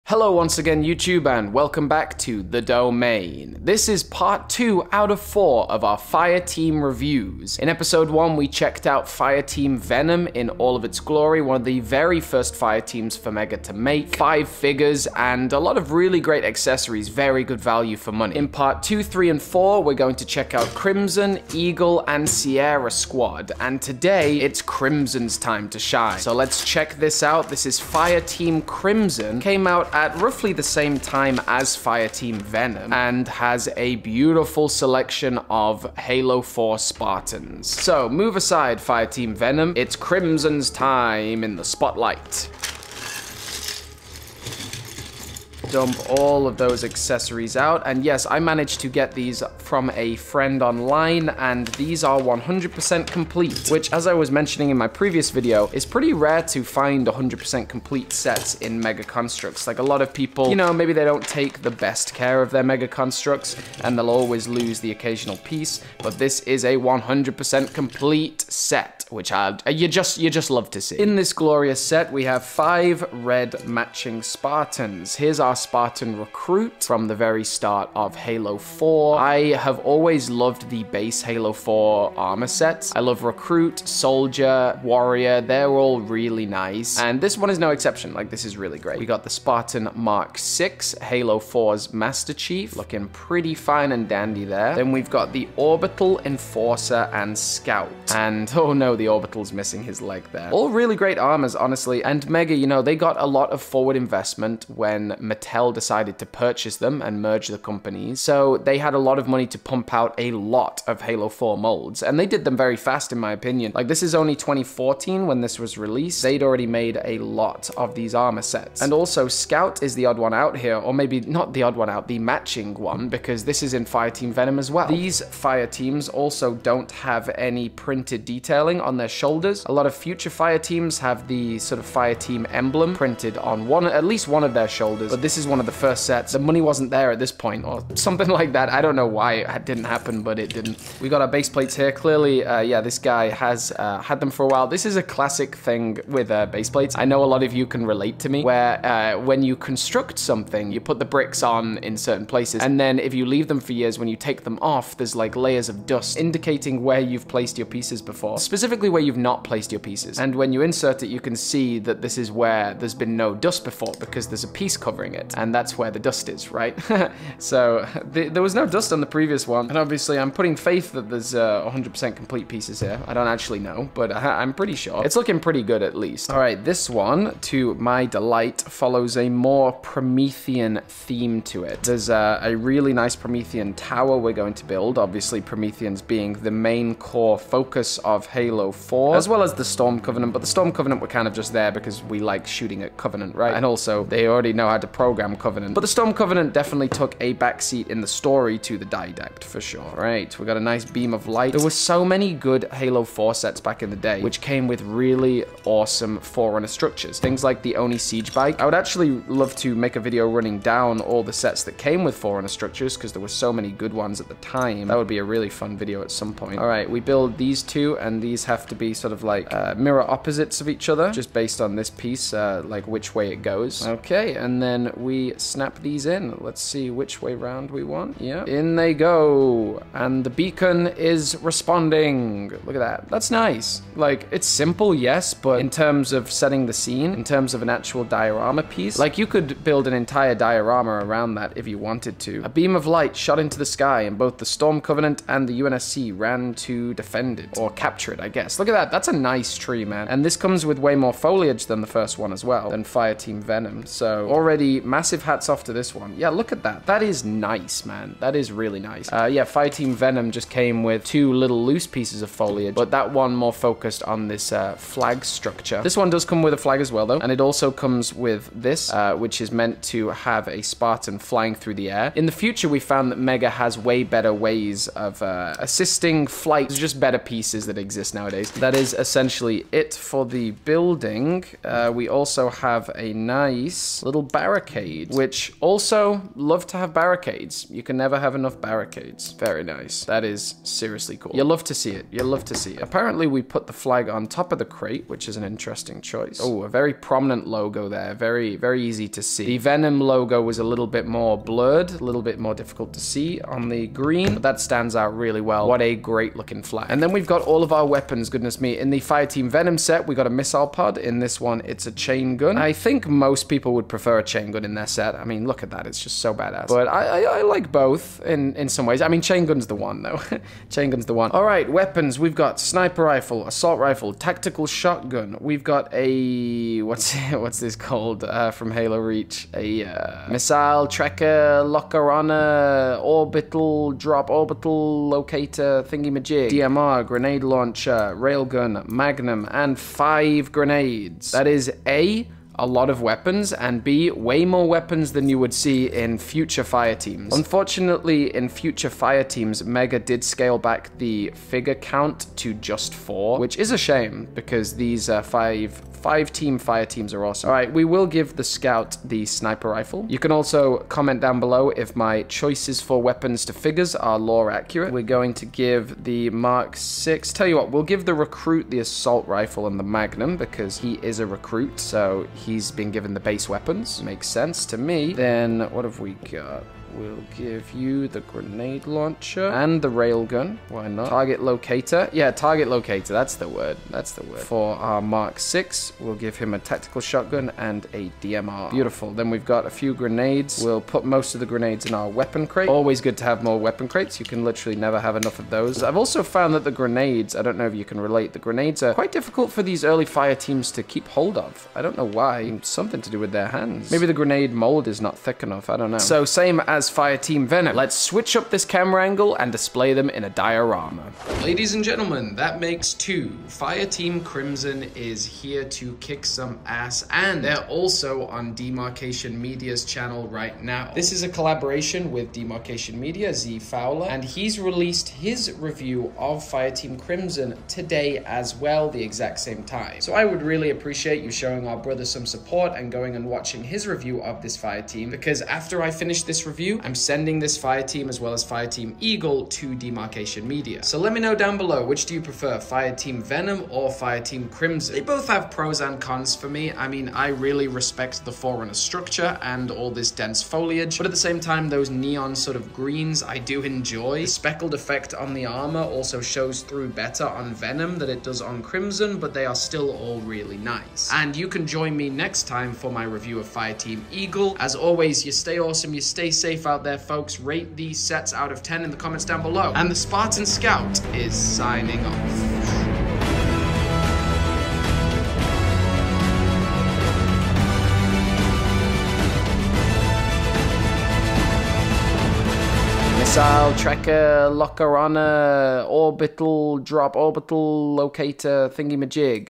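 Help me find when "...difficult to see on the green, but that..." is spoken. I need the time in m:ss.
5:02.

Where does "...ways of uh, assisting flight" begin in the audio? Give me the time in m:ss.
4:34.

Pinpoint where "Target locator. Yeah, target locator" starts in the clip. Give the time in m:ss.
6:21.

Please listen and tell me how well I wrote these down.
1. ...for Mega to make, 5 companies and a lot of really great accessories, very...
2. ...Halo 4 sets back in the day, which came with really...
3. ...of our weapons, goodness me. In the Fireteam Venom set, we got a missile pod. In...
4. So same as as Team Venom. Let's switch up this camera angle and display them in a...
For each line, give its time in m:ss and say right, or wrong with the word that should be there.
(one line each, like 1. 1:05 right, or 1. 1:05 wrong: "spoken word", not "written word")
1. 0:13 wrong: "figures", not "companies"
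2. 3:22 right
3. 5:07 right
4. 6:45 right.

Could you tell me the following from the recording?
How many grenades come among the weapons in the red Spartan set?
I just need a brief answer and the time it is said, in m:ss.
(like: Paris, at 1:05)
5, at 5:39.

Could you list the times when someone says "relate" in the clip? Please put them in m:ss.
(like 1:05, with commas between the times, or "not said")
2:27, 6:37.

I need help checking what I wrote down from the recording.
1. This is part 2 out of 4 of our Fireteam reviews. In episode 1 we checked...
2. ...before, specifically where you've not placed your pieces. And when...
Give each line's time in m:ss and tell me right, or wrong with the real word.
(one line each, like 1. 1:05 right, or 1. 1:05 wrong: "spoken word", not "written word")
1. 0:03 right
2. 2:38 right.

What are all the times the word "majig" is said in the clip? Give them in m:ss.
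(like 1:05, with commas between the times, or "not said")
5:36, 8:09.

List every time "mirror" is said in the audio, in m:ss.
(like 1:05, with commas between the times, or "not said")
3:39.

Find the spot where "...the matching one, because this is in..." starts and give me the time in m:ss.
2:02.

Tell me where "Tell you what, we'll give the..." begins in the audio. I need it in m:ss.
6:07.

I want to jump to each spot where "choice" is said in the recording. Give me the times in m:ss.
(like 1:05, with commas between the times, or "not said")
4:56, 6:02.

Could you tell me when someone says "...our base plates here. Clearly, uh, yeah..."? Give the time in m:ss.
2:21.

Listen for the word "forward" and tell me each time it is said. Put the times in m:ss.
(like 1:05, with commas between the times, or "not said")
1:43.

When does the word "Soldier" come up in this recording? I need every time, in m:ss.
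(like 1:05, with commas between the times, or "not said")
1:23.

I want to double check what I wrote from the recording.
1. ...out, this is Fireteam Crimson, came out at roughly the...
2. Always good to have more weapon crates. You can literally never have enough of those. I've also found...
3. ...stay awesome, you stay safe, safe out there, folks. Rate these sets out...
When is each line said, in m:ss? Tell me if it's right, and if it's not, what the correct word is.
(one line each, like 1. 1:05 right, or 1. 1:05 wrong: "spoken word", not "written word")
1. 0:27 right
2. 6:32 right
3. 7:45 right.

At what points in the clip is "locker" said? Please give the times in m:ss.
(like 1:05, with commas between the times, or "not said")
5:31, 8:04.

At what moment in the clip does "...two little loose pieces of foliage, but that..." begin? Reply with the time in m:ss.
4:21.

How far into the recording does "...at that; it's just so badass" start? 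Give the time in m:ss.
5:15.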